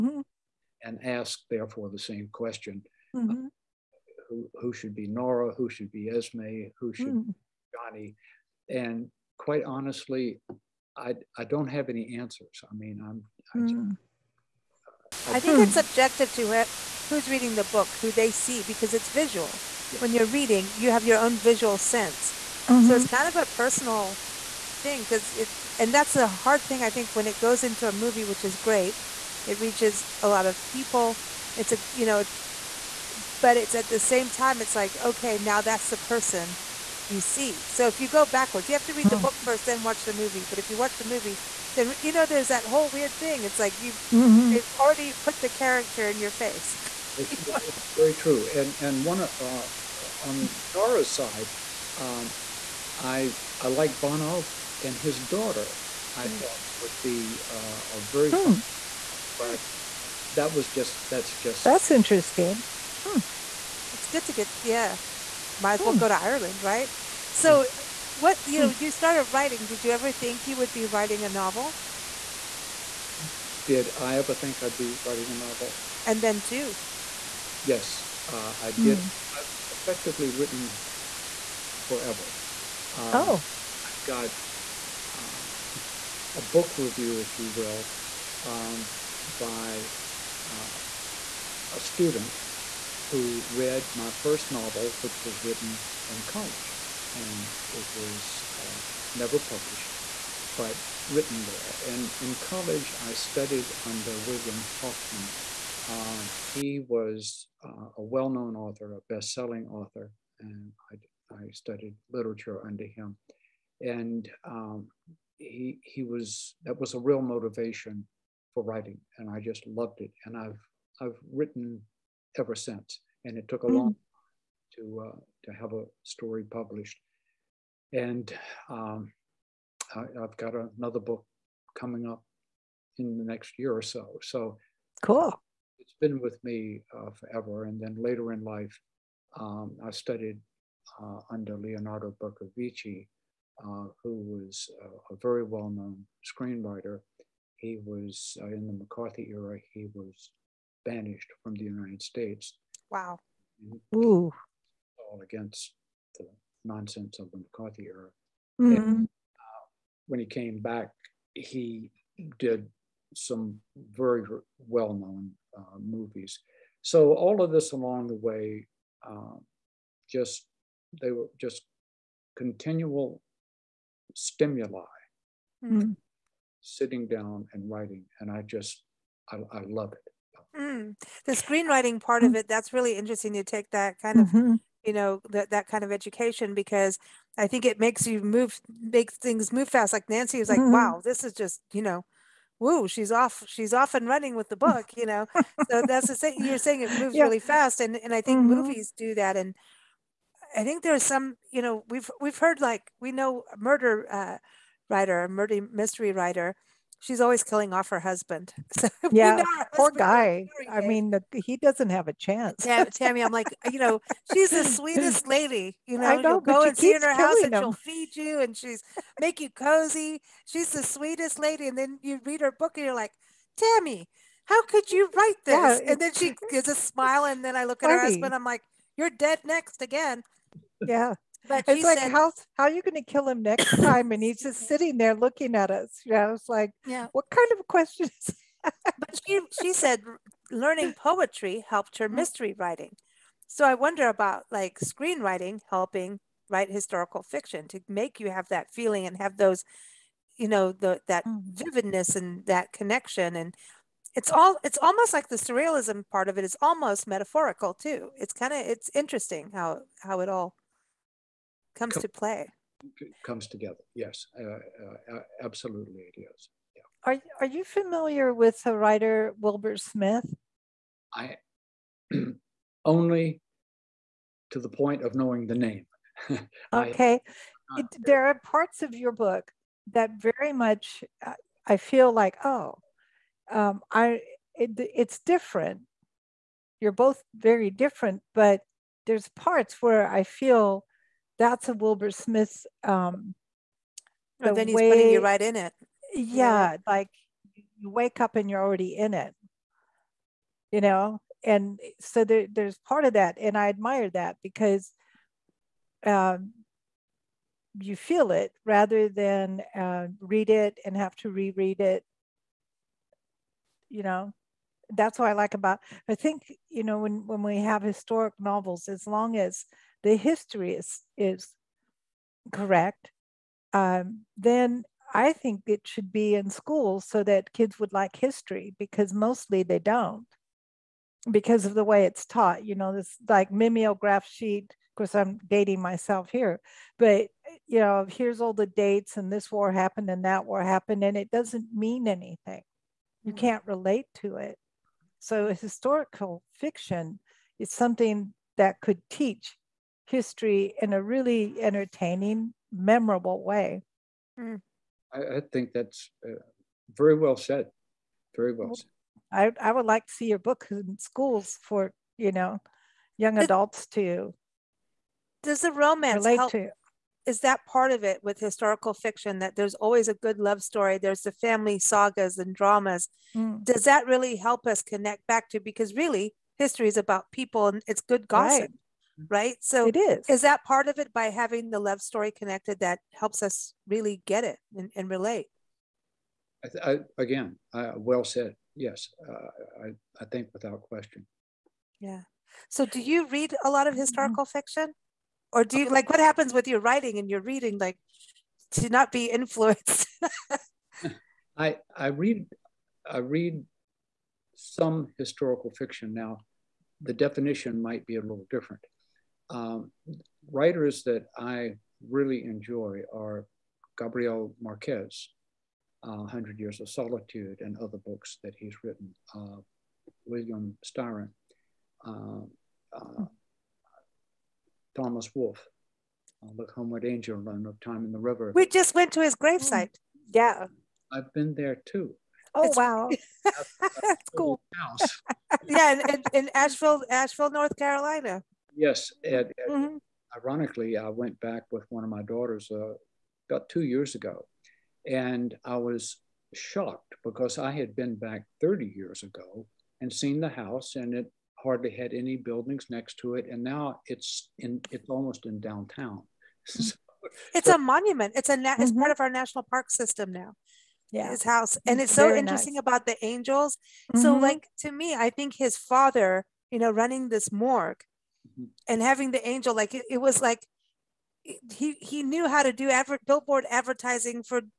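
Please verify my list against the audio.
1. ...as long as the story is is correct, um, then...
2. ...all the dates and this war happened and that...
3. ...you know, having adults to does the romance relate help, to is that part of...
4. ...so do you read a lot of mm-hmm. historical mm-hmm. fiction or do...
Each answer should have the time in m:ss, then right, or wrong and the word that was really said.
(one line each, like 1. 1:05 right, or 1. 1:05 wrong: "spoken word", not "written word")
1. 5:18 wrong: "history", not "story"
2. 5:38 right
3. 6:02 wrong: "young", not "having"
4. 6:32 right.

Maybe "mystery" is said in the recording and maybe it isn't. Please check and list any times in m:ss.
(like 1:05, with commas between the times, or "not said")
3:25, 4:02.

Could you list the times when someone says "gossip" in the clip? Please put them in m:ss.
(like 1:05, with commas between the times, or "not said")
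6:18.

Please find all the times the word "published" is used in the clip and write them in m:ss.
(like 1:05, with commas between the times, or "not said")
1:39, 2:06.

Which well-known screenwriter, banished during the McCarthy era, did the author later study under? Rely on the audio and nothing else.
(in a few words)
Leonardo Bercovici.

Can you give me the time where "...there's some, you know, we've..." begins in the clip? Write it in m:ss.
3:20.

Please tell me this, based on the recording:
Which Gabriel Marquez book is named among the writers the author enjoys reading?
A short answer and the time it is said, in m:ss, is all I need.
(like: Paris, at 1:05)
100 Years of Solitude, at 6:56.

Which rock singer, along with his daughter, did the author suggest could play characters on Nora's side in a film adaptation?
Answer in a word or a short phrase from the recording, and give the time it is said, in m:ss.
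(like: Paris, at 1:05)
Bono, at 0:54.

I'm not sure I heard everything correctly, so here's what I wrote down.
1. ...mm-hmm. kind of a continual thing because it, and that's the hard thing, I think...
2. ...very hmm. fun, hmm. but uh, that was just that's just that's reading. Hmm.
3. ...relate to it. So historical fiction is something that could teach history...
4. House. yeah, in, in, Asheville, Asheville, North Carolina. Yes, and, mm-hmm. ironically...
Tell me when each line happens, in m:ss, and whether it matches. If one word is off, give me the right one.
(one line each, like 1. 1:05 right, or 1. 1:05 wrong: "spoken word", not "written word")
1. 0:23 wrong: "personal", not "continual"
2. 0:58 wrong: "interesting", not "reading"
3. 5:43 right
4. 7:14 right.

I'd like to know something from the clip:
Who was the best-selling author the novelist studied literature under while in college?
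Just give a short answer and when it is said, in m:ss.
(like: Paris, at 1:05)
William Hoffman, at 1:44.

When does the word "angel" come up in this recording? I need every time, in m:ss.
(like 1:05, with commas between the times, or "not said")
7:07, 7:43, 7:49.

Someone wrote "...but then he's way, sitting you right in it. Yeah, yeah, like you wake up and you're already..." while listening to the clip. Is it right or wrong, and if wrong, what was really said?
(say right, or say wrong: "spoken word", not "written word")
wrong: "putting", not "sitting".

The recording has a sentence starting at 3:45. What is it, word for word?
Yeah, and then she gives a smile and then I look at funny.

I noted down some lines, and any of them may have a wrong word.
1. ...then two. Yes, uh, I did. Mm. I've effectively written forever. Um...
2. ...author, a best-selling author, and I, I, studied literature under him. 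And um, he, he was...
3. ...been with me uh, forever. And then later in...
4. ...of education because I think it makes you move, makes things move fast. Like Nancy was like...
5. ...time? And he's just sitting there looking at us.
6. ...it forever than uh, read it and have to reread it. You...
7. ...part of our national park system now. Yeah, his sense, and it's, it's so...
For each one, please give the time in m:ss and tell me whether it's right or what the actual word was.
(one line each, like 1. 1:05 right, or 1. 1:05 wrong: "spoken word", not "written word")
1. 1:16 right
2. 1:48 right
3. 2:16 right
4. 3:05 right
5. 3:53 right
6. 5:08 wrong: "rather", not "forever"
7. 7:38 wrong: "house", not "sense".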